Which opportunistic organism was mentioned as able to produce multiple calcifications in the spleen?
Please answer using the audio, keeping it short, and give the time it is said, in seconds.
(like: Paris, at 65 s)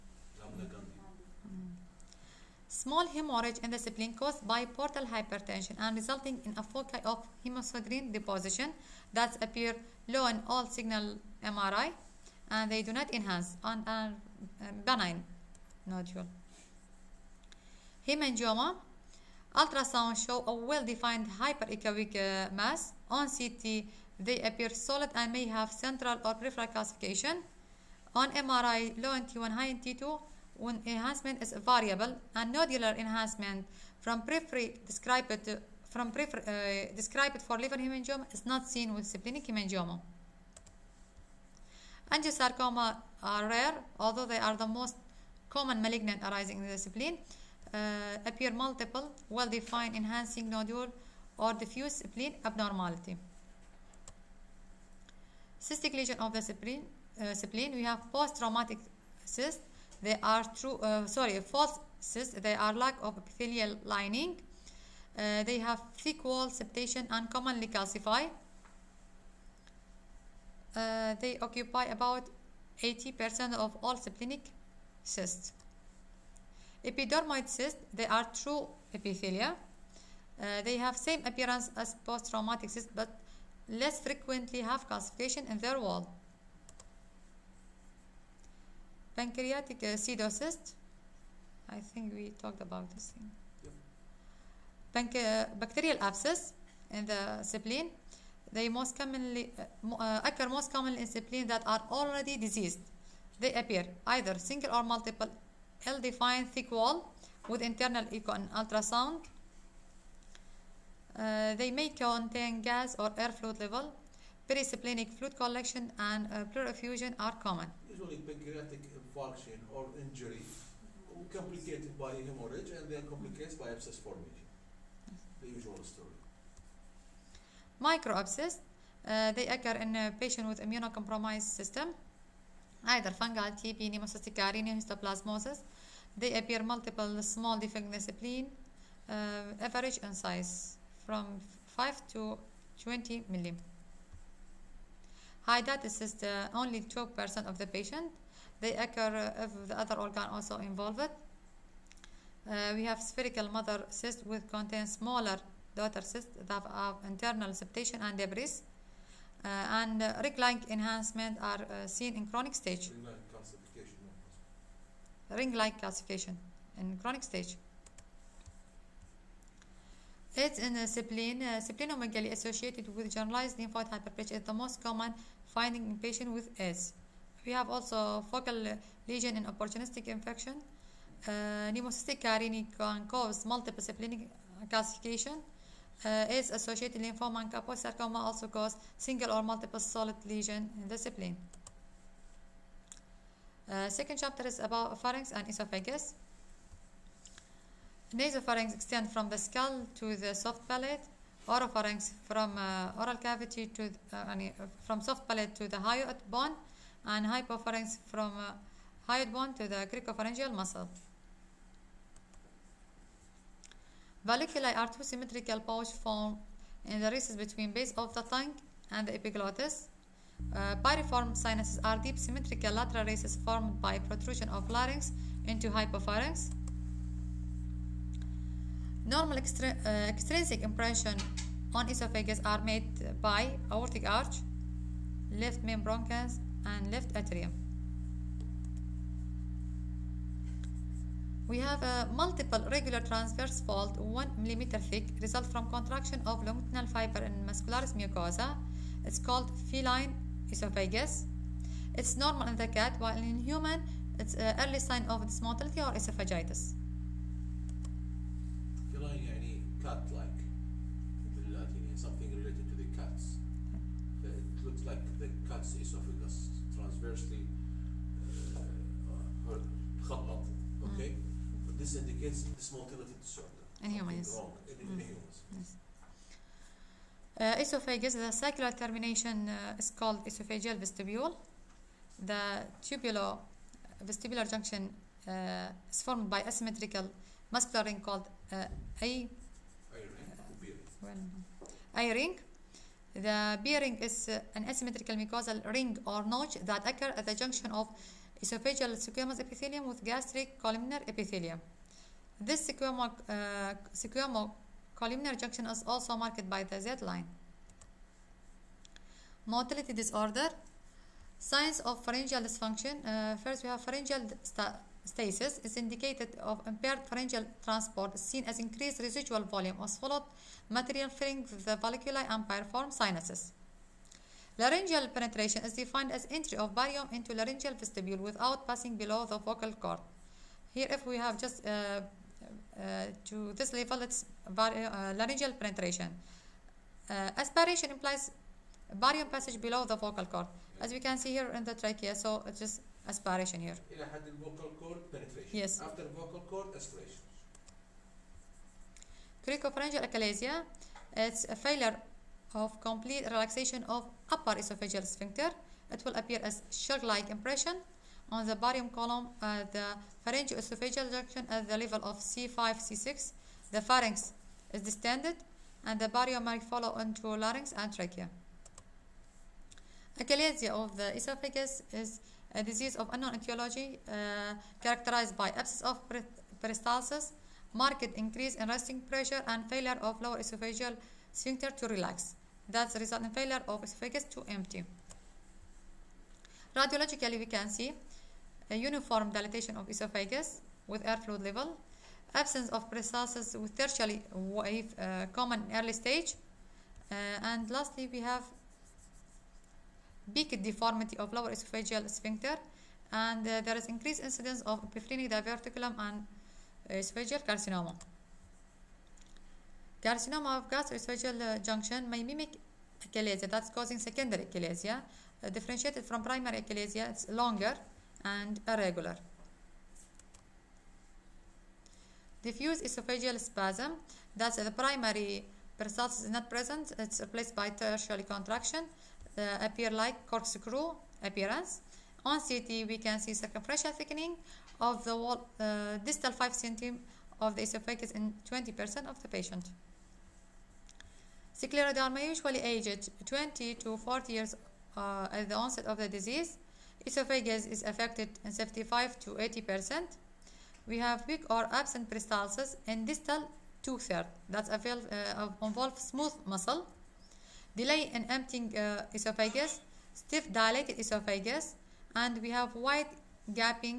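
Pneumocystis carinii, at 181 s.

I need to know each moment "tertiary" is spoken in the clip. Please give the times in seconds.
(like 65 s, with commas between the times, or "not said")
393 s, 427 s.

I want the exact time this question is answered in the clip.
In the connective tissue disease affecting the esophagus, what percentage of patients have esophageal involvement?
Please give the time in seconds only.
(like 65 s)
448 s.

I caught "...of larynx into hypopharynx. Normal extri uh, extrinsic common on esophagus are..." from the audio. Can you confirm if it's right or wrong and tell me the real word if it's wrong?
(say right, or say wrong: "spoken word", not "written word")
wrong: "impression", not "common".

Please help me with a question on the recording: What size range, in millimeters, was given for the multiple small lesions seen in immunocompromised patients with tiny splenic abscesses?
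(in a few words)
5 to 20 millimeters.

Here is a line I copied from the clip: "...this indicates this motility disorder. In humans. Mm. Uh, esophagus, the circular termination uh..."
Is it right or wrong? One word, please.
right.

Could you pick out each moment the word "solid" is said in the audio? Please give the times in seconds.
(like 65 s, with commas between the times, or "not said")
24 s, 189 s.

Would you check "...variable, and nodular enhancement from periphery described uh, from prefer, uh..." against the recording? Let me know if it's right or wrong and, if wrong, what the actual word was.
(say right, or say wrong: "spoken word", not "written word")
right.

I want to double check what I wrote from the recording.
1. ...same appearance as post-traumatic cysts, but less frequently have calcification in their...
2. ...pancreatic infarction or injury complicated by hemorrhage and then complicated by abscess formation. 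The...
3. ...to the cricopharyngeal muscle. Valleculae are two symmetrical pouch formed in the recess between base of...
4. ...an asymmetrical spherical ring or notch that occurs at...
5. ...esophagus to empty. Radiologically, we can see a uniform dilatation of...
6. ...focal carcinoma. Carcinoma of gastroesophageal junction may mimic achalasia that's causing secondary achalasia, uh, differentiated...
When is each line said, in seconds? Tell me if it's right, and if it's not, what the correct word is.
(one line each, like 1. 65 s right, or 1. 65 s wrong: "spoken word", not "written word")
1. 80 s right
2. 118 s right
3. 209 s right
4. 294 s wrong: "mucosal", not "spherical"
5. 383 s right
6. 406 s wrong: "esophageal", not "focal".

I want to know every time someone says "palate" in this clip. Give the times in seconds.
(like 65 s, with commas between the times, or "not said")
200 s, 205 s.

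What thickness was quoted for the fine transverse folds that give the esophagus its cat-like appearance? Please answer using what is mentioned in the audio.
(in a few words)
1 millimeter.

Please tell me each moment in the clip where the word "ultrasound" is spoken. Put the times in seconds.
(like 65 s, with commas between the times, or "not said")
19 s, 108 s.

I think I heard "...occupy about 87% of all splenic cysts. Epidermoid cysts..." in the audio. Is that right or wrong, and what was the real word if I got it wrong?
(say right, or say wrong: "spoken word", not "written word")
wrong: "80", not "87".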